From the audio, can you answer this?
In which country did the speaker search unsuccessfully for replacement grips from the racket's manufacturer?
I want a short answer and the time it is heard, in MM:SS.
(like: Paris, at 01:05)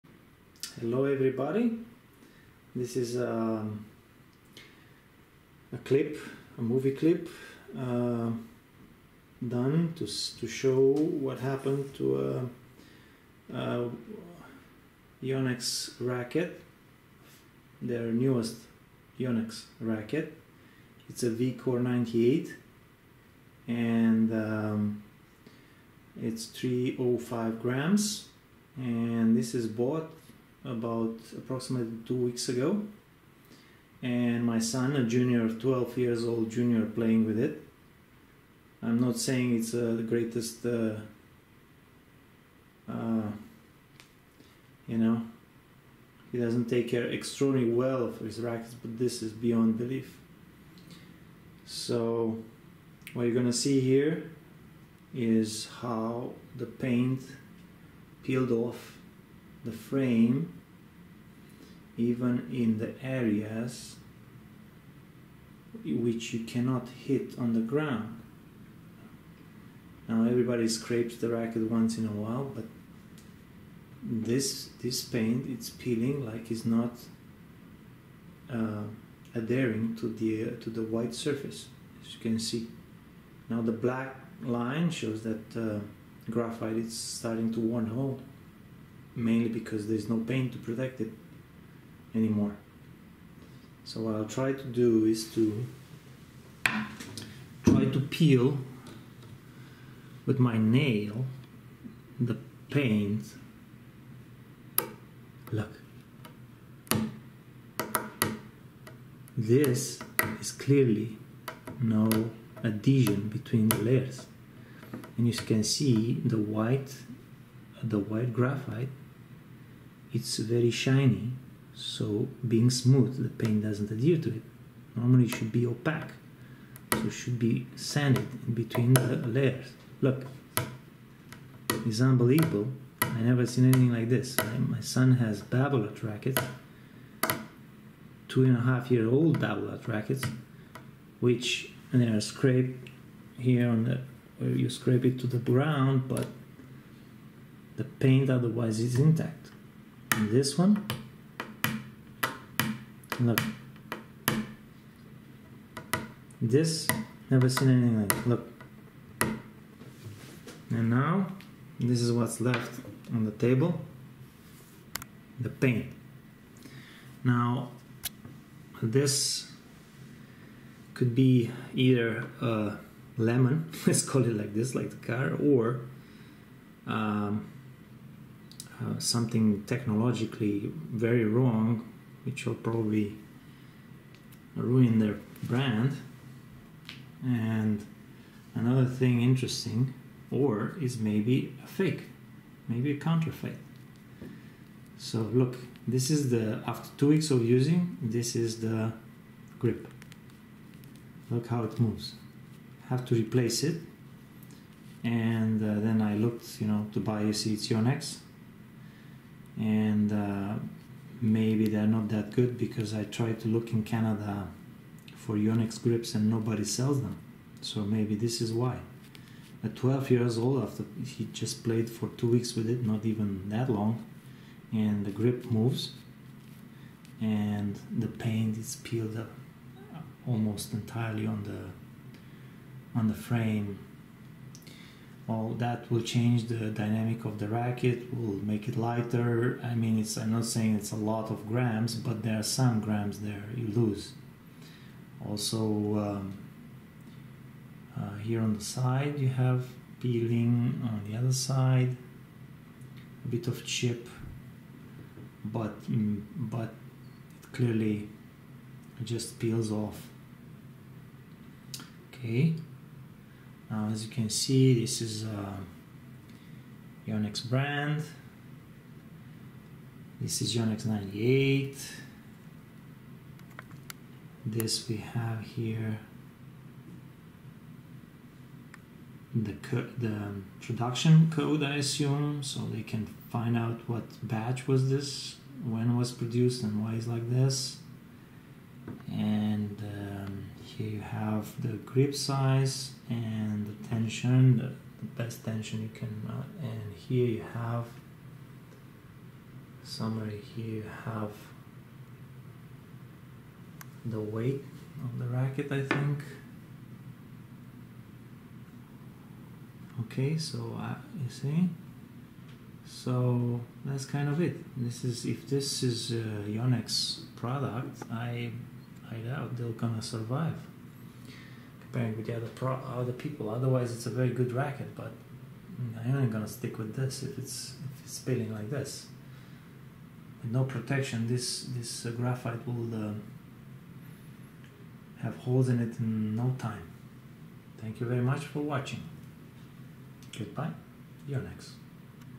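Canada, at 03:33.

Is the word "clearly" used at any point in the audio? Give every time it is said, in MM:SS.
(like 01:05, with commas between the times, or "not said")
01:50, 04:17.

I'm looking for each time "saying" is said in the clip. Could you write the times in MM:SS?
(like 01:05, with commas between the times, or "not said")
00:39, 04:00.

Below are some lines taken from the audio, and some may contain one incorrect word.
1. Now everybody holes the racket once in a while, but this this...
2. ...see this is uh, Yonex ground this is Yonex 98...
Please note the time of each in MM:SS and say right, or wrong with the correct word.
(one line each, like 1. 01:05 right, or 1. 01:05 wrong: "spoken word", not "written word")
1. 01:10 wrong: "scrapes", not "holes"
2. 04:24 wrong: "brand", not "ground".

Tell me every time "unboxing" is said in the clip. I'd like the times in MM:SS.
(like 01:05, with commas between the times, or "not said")
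not said.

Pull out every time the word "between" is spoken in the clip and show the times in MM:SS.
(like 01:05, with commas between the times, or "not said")
01:53, 02:08.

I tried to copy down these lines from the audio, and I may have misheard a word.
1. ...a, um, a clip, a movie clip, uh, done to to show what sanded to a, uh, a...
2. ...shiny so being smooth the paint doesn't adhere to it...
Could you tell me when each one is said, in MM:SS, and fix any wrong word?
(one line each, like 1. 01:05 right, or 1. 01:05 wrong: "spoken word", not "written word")
1. 00:03 wrong: "happened", not "sanded"
2. 02:00 right.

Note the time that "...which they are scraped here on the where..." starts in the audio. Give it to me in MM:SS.
02:21.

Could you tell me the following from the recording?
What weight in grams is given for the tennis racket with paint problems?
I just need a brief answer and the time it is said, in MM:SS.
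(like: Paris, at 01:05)
305 grams, at 00:26.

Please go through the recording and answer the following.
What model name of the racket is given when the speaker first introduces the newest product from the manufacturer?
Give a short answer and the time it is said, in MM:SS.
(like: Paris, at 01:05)
V Core 98, at 00:21.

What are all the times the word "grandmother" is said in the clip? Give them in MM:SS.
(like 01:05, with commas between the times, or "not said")
not said.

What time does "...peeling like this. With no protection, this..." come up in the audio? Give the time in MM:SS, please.
05:28.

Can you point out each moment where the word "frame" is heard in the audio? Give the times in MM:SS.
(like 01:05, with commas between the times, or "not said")
00:59, 03:53.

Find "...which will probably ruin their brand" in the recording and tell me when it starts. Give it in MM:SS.
03:02.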